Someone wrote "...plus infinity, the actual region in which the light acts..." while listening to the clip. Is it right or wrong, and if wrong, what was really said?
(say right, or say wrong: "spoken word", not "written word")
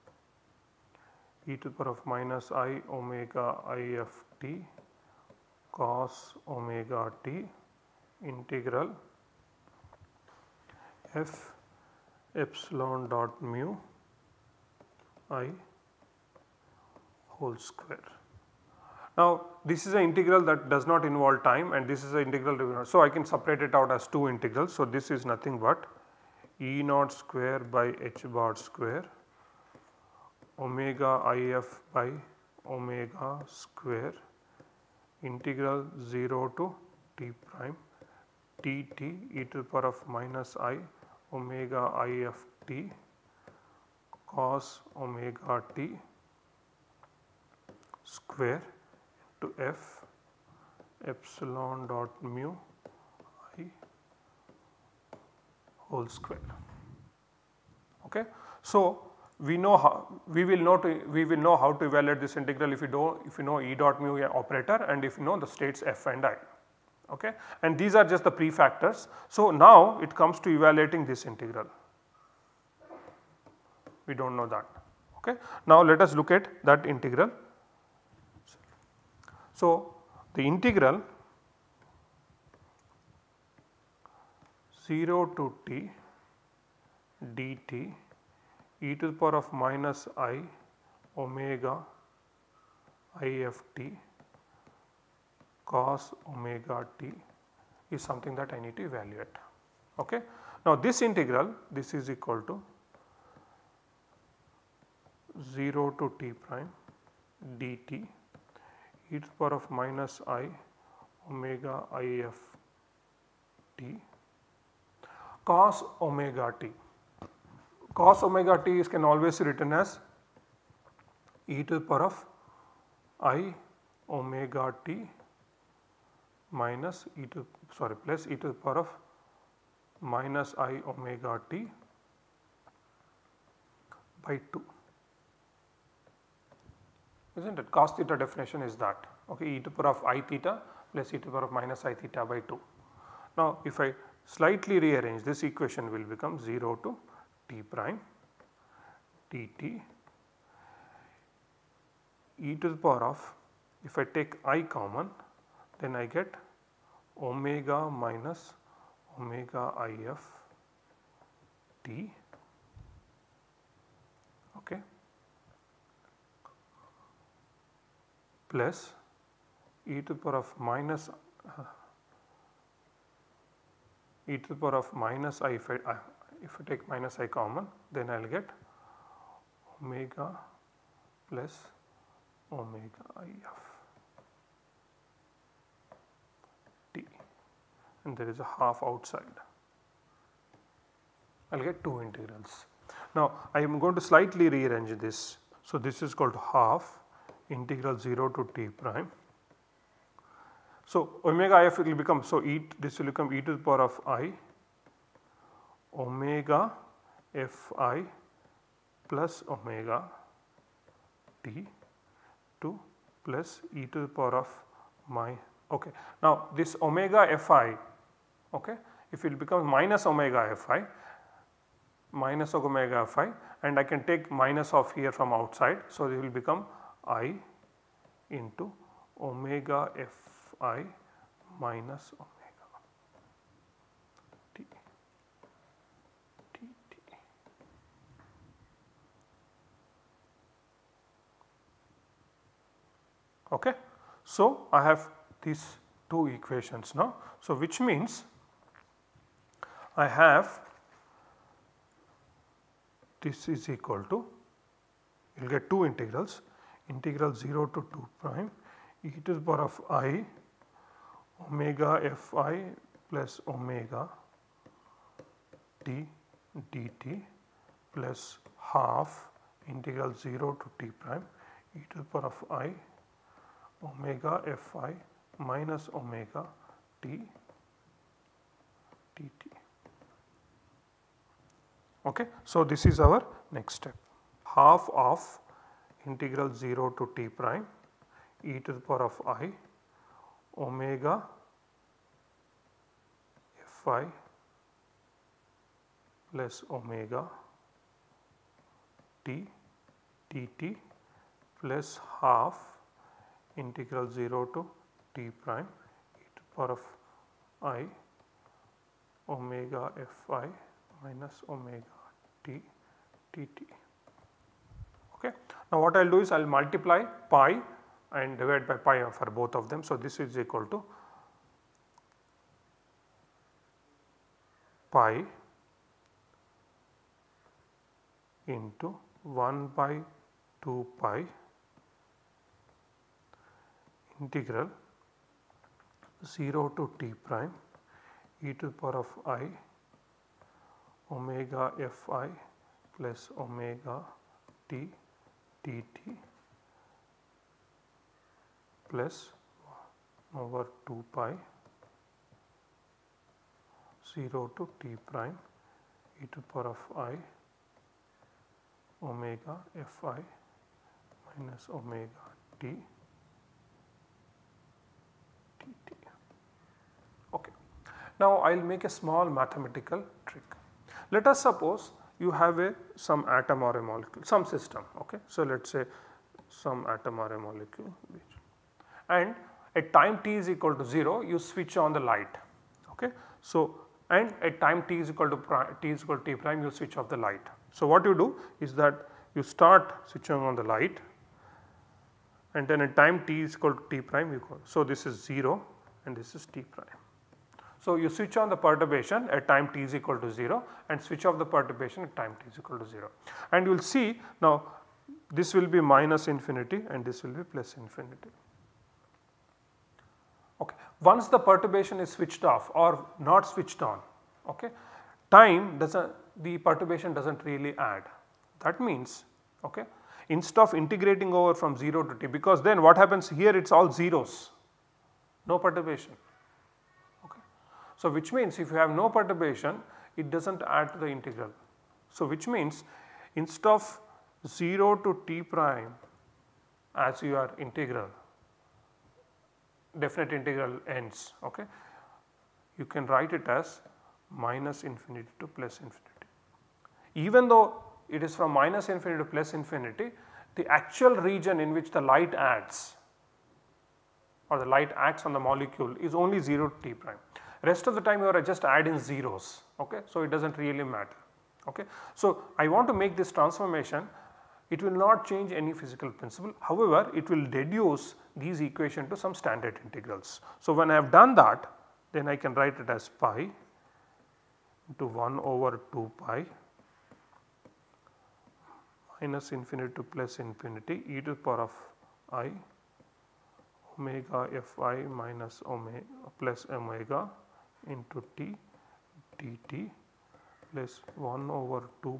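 right.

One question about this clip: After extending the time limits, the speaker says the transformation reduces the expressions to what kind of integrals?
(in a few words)
Standard integrals.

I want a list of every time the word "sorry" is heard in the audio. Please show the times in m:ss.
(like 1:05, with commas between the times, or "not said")
2:07.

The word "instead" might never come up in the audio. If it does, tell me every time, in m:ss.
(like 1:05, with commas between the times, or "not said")
7:00, 7:13.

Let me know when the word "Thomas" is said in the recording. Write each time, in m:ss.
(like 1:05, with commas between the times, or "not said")
not said.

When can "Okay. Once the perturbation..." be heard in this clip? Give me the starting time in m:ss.
6:50.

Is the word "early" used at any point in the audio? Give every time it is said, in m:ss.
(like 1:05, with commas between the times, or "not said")
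not said.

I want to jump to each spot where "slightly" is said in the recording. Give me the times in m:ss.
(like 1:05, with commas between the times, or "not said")
2:24, 3:14.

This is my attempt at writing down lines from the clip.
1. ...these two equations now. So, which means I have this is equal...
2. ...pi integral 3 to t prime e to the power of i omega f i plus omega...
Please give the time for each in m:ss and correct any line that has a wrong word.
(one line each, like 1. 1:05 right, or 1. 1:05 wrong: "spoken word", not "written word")
1. 4:05 right
2. 5:30 wrong: "0", not "3".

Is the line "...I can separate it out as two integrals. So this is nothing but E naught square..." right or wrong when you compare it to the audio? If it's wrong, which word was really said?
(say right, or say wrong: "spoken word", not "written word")
right.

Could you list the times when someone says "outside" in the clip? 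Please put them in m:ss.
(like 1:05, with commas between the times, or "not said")
3:08, 3:45.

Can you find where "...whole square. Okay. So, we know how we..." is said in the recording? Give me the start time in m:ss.
0:55.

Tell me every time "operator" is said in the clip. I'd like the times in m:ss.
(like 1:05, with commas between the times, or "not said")
1:04.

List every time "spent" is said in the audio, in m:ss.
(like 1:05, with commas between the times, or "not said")
not said.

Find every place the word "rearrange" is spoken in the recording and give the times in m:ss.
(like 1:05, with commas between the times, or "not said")
2:24, 3:14.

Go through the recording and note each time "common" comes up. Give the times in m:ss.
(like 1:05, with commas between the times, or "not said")
2:34, 2:57.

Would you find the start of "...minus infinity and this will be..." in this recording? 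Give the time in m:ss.
6:45.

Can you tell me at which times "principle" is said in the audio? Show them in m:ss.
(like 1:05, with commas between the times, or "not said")
7:46.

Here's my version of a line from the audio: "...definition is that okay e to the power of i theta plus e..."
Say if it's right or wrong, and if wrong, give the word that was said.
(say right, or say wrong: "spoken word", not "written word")
right.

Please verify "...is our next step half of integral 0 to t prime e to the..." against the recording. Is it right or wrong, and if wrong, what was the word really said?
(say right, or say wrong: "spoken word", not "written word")
right.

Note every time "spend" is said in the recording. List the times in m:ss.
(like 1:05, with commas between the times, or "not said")
not said.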